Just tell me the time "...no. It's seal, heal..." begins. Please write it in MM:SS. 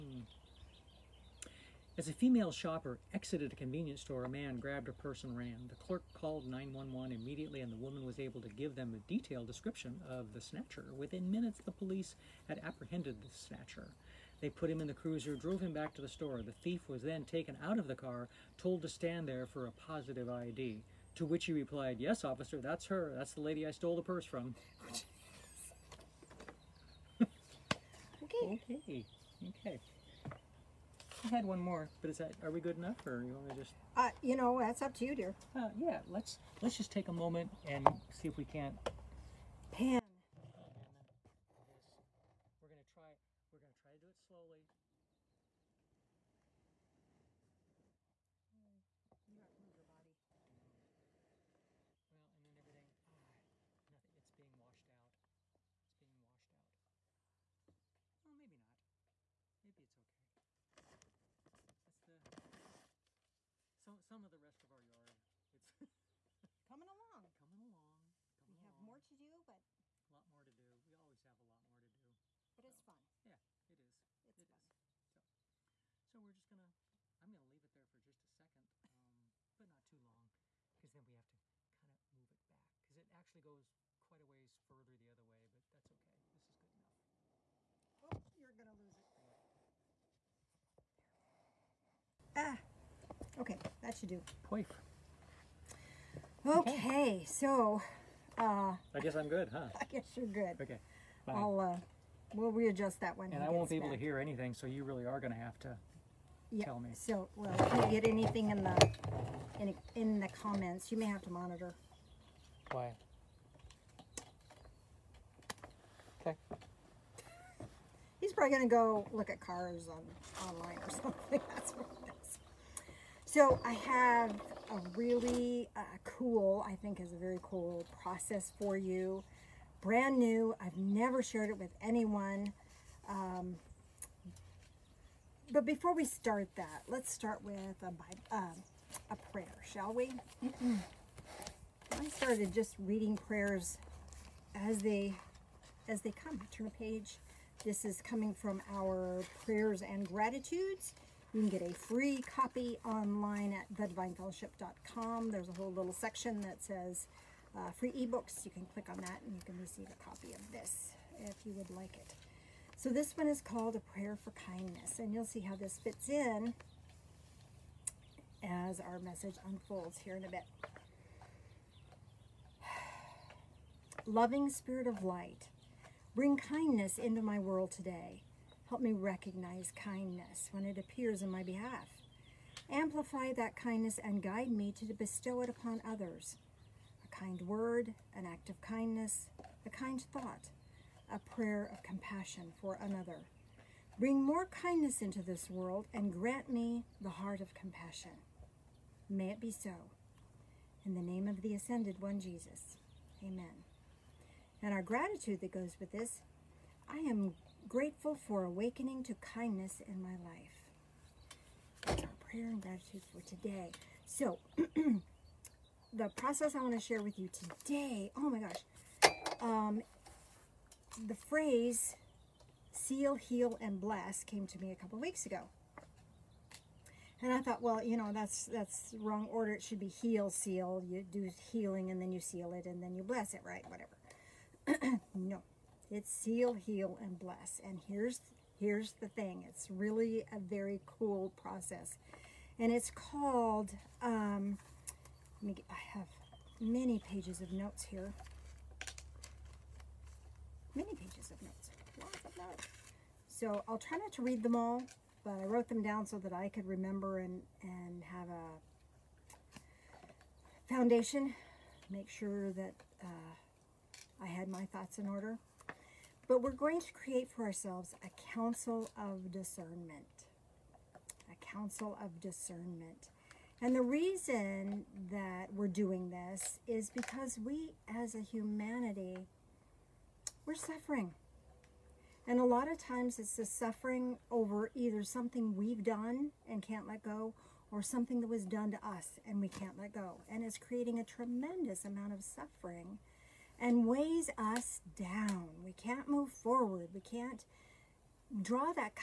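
03:55.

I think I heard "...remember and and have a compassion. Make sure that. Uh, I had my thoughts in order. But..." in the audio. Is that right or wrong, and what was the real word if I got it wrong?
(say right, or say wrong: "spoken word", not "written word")
wrong: "foundation", not "compassion".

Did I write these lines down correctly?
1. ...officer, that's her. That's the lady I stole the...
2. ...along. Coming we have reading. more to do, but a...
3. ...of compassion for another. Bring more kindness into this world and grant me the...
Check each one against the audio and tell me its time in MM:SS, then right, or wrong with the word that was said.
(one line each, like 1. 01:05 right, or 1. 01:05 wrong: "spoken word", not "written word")
1. 00:22 right
2. 01:07 wrong: "along", not "reading"
3. 03:11 right.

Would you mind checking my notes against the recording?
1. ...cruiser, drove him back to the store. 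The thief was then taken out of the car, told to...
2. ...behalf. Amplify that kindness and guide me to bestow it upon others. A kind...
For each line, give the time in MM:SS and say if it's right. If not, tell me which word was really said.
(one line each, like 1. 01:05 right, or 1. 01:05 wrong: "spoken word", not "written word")
1. 00:14 right
2. 03:01 right.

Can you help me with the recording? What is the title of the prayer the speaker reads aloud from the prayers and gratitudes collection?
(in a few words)
A Prayer for Kindness.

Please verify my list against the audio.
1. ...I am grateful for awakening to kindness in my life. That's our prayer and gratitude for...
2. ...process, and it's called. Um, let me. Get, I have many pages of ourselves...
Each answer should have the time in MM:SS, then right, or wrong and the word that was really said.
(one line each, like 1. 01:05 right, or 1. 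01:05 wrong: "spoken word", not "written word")
1. 03:26 right
2. 04:01 wrong: "notes", not "ourselves".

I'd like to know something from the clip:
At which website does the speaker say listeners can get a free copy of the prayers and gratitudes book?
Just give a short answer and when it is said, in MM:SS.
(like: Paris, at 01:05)
thedivinefellowship.com, at 02:33.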